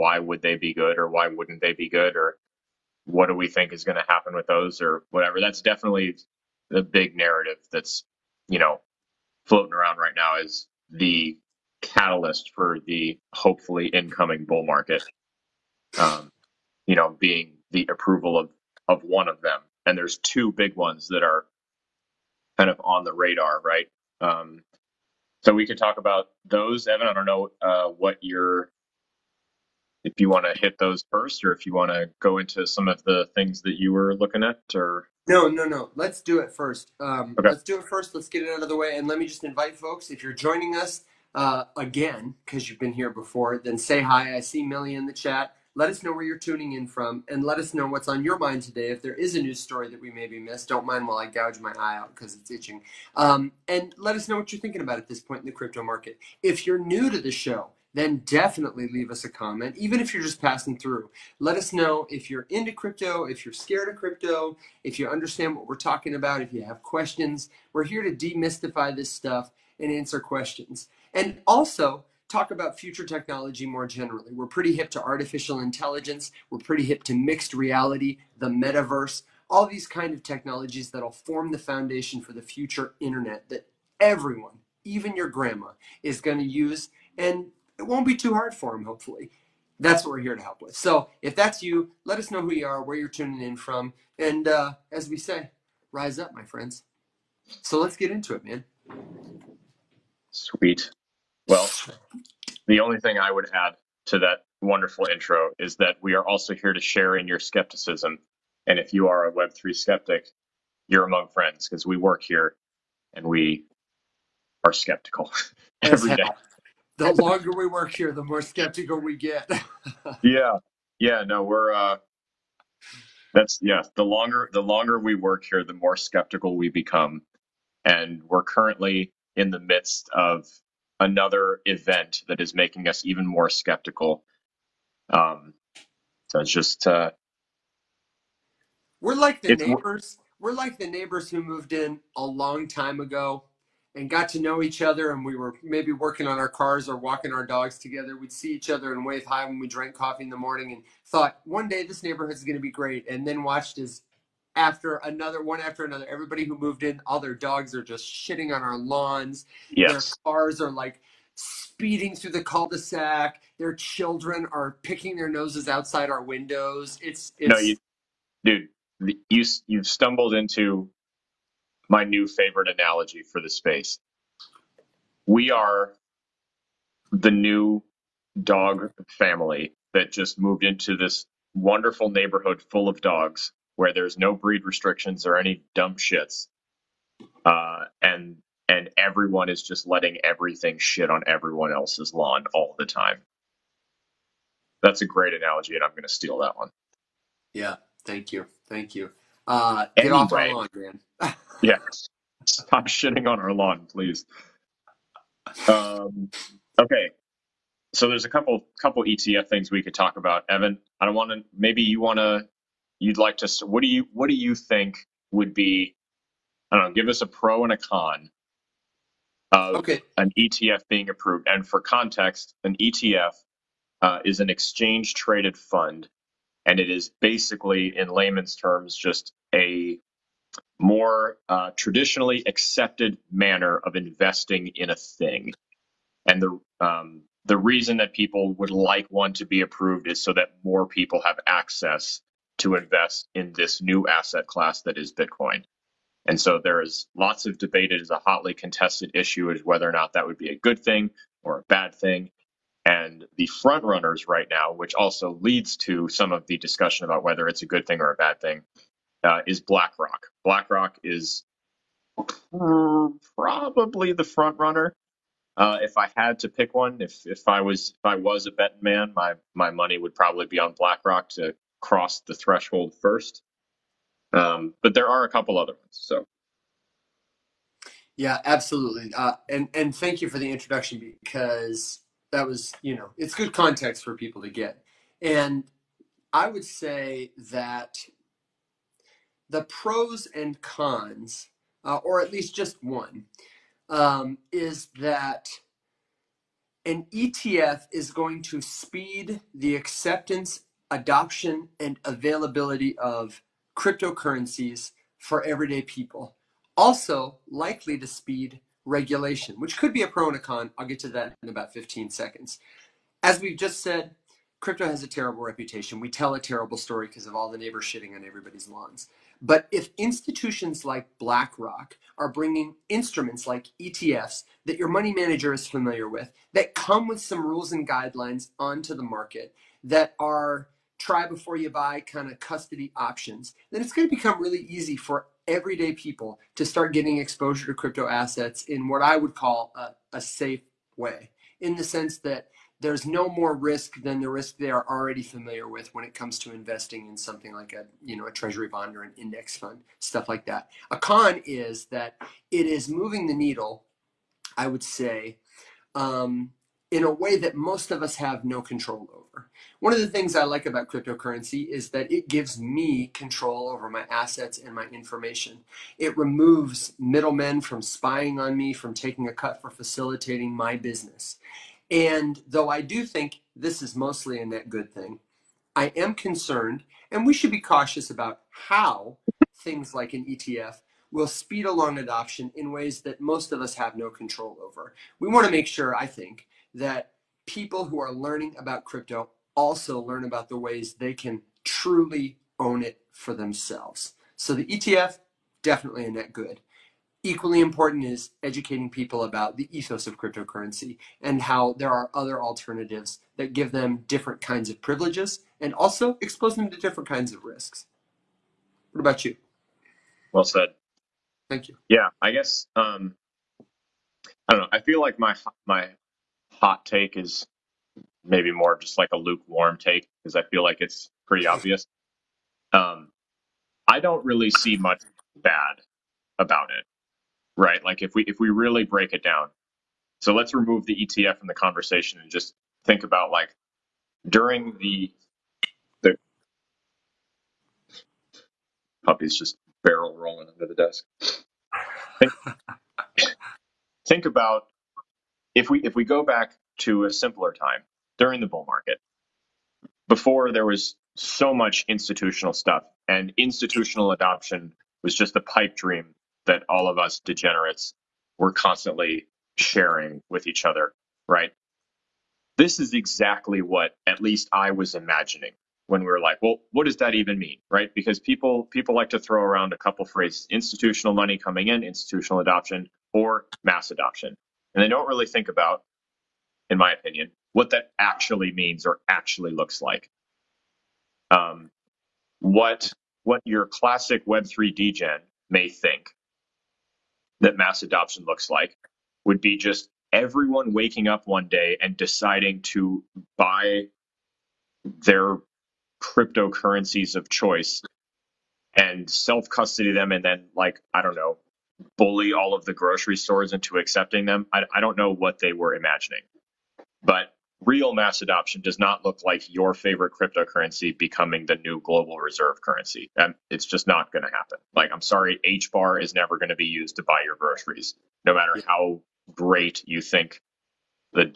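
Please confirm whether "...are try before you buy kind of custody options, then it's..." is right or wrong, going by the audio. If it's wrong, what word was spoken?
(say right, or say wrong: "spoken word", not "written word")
right.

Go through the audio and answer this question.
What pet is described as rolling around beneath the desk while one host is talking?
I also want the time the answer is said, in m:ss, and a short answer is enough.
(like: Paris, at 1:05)
the puppy, at 7:19.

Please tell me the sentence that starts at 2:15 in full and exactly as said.
Um, so it's just uh, We're like the neighbors.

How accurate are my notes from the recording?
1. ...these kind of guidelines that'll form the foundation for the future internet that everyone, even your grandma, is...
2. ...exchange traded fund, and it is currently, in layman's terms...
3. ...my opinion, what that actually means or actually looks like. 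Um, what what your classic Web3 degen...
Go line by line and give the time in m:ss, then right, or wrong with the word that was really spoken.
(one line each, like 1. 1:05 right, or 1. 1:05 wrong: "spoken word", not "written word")
1. 1:19 wrong: "technologies", not "guidelines"
2. 3:44 wrong: "basically", not "currently"
3. 7:56 right.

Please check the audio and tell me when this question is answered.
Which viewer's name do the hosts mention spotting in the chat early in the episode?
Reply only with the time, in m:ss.
0:44.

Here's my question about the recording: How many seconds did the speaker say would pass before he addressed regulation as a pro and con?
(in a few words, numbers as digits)
15.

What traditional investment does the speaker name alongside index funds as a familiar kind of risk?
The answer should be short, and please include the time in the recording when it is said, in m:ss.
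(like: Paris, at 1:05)
treasury bond, at 5:48.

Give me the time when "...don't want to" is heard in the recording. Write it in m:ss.
3:31.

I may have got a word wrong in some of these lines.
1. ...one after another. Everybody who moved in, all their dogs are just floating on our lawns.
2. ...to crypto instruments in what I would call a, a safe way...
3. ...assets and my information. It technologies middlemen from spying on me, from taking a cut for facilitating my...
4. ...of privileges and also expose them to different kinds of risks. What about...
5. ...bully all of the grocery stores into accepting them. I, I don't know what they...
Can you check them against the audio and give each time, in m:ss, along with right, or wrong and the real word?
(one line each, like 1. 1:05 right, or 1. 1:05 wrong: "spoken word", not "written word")
1. 2:35 wrong: "shitting", not "floating"
2. 5:37 wrong: "assets", not "instruments"
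3. 6:04 wrong: "removes", not "technologies"
4. 6:44 right
5. 8:21 right.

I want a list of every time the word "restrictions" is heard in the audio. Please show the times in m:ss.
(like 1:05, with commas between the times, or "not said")
3:04.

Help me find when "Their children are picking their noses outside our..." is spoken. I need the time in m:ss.
2:43.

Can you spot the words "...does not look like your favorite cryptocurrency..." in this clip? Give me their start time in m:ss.
8:28.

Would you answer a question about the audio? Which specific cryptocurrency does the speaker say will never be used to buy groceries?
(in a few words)
HBAR.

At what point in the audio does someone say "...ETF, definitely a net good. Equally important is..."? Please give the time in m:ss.
6:34.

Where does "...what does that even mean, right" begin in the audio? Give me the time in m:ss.
7:46.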